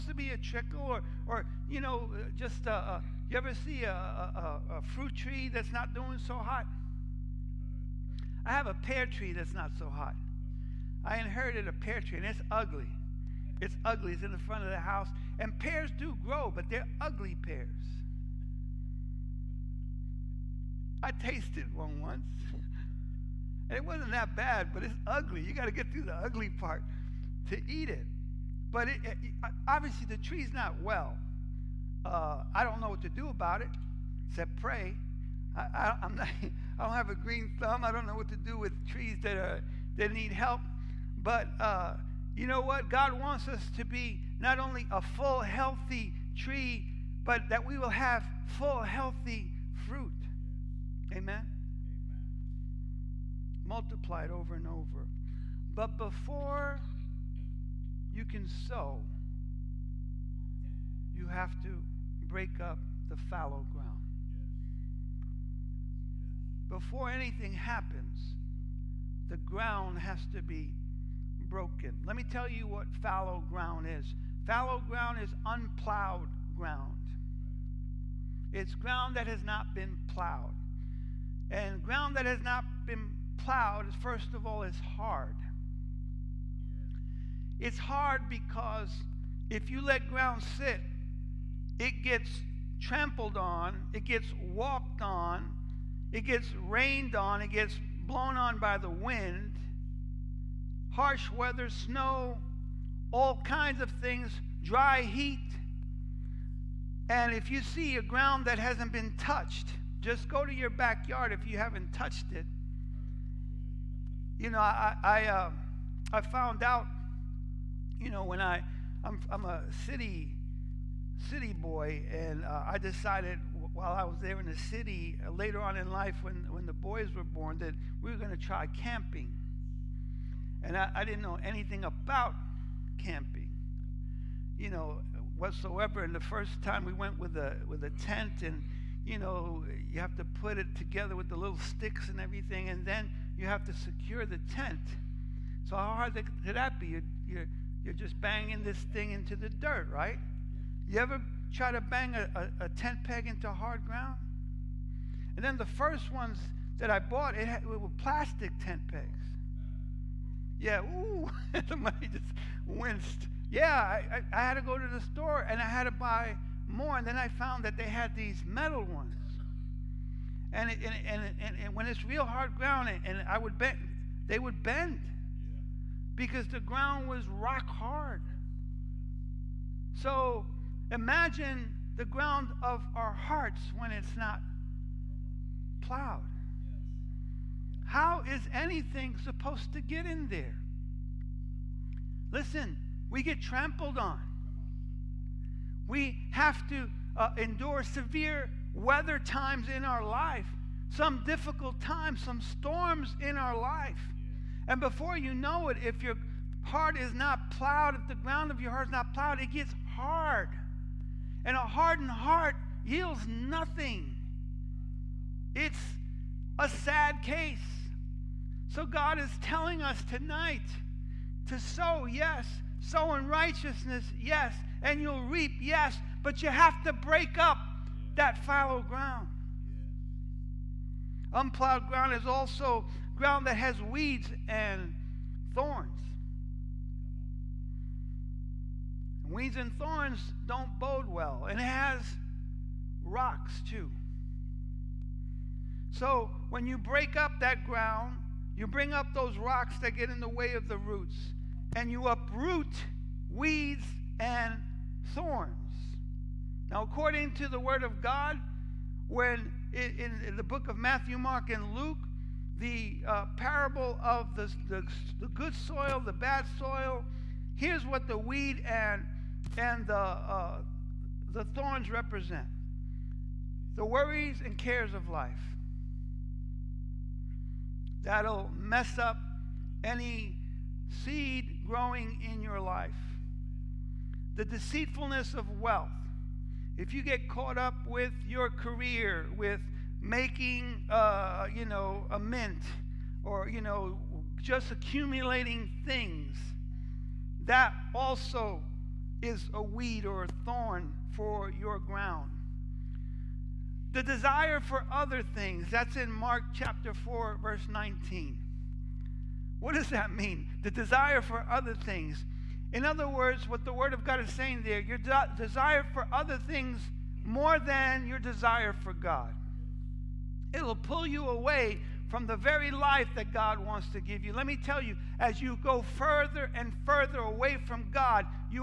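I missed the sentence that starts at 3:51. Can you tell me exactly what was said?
Unplowed ground is also ground that has weeds and thorns.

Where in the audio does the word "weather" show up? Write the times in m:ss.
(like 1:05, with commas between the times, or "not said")
1:41, 3:18.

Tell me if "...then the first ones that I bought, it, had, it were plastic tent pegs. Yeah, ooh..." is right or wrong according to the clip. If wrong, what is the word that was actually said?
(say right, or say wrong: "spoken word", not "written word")
right.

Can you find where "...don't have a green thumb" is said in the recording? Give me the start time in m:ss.
0:36.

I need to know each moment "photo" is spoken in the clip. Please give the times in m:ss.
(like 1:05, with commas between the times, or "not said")
not said.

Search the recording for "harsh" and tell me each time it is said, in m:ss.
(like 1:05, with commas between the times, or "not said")
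1:40.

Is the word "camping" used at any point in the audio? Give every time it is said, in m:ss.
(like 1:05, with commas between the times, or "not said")
2:08, 2:12.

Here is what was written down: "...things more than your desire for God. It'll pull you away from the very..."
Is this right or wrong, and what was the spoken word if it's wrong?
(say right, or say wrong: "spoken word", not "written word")
right.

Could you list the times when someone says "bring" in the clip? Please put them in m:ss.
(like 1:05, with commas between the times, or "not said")
4:08.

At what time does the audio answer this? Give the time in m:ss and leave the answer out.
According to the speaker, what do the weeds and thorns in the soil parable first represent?
4:33.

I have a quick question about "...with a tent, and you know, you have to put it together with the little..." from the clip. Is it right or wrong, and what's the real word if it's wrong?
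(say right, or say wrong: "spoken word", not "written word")
right.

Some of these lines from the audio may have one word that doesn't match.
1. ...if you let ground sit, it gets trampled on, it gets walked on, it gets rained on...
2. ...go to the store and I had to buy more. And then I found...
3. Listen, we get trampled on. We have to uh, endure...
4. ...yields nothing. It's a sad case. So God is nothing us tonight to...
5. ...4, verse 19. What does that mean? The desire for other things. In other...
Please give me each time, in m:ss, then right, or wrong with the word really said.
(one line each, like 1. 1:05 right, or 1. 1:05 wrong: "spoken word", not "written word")
1. 1:29 right
2. 2:44 right
3. 3:12 right
4. 3:32 wrong: "telling", not "nothing"
5. 5:06 right.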